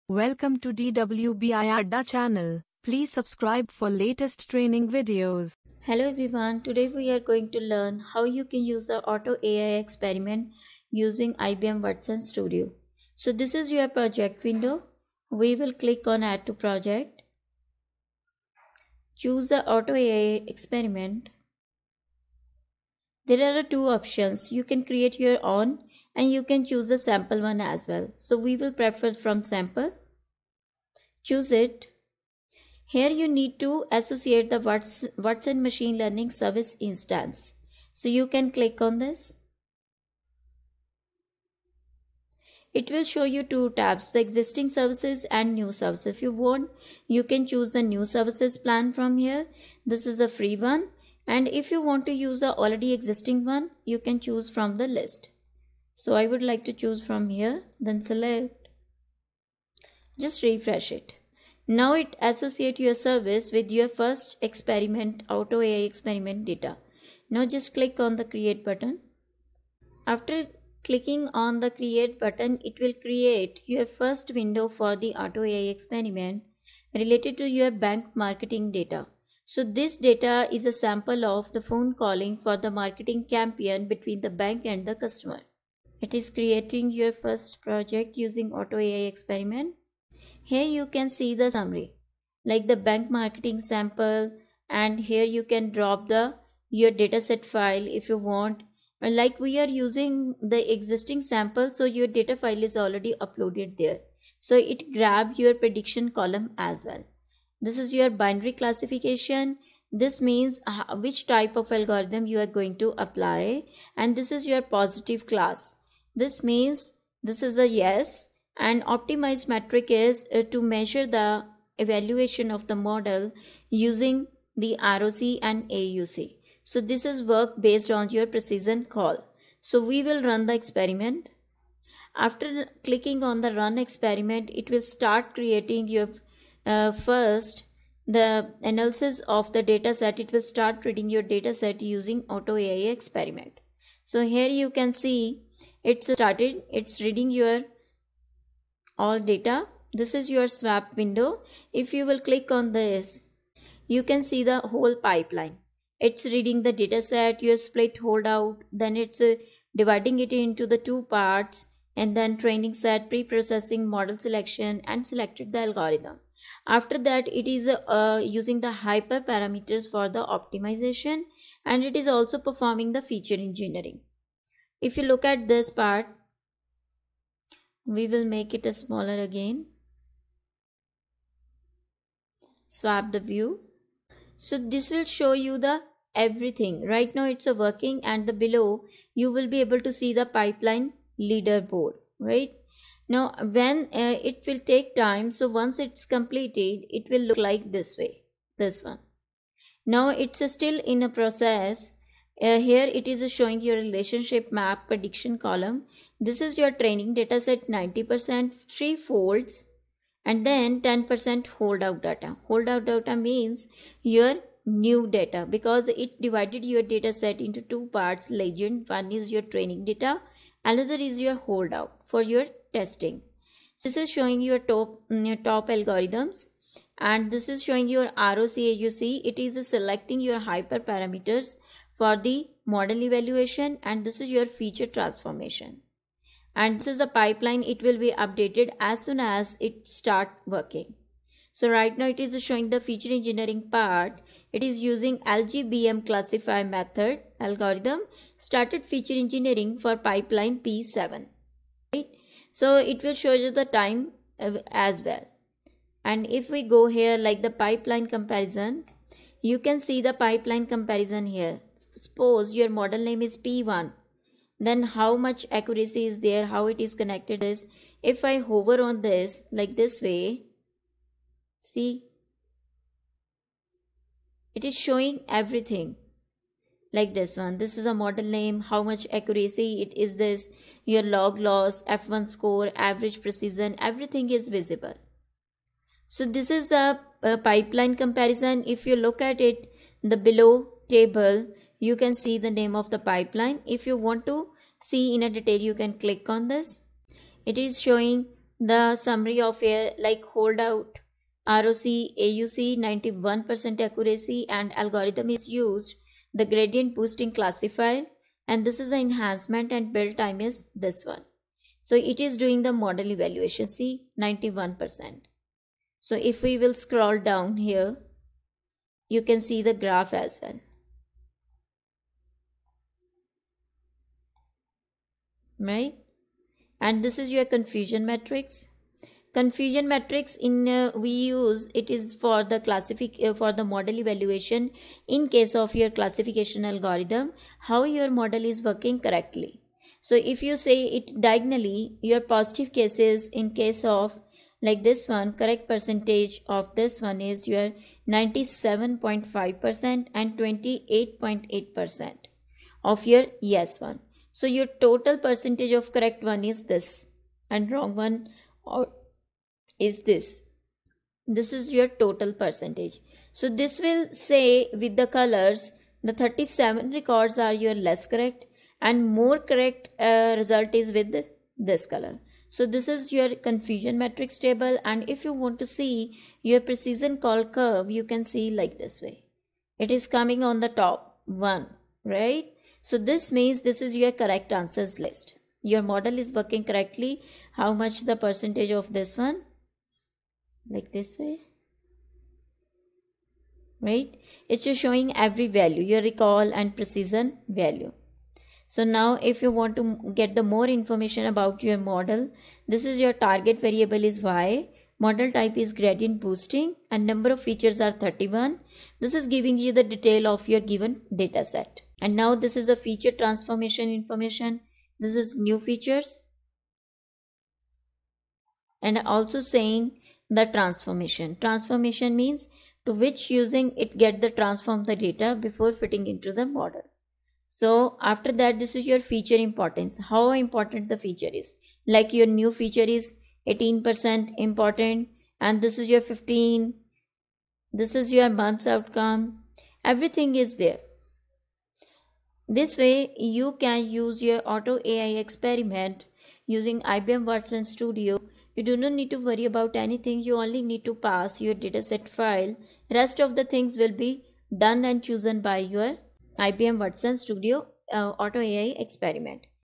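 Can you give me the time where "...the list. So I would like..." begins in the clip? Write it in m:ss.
0:54.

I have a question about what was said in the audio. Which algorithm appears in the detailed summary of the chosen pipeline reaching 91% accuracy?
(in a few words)
Gradient boosting classifier.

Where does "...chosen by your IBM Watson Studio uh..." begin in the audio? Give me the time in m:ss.
7:35.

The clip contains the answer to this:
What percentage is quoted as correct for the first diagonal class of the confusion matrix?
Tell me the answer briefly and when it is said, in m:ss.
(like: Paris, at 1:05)
97.5%, at 5:48.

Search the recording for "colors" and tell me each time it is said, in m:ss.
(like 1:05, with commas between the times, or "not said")
6:05, 6:11.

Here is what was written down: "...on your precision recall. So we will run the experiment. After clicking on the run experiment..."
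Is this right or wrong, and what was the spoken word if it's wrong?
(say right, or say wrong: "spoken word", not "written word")
right.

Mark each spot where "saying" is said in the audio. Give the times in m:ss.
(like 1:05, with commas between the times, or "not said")
6:59.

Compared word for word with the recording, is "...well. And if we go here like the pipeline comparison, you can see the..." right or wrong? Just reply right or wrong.
right.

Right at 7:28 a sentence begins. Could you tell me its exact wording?
You do not need to worry about anything.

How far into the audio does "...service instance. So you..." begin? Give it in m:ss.
0:36.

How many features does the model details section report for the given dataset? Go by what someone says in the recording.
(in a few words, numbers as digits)
31.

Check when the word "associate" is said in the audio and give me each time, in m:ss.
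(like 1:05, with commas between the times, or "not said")
0:33, 1:02.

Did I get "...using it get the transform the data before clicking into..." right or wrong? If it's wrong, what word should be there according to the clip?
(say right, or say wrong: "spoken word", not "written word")
wrong: "fitting", not "clicking".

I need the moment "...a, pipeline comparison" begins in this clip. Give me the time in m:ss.
4:47.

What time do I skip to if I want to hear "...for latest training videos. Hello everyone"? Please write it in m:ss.
0:03.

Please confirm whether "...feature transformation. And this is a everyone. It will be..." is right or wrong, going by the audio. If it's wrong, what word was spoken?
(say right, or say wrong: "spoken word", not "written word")
wrong: "pipeline", not "everyone".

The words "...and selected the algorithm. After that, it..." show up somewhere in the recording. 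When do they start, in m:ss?
2:44.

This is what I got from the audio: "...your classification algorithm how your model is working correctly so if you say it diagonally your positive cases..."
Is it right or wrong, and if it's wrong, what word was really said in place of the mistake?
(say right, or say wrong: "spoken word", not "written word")
right.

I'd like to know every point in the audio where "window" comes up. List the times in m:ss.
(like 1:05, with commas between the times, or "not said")
0:14, 1:14, 2:30.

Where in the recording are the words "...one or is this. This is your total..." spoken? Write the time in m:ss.
5:57.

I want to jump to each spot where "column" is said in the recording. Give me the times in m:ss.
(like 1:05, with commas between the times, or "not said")
1:46, 3:25.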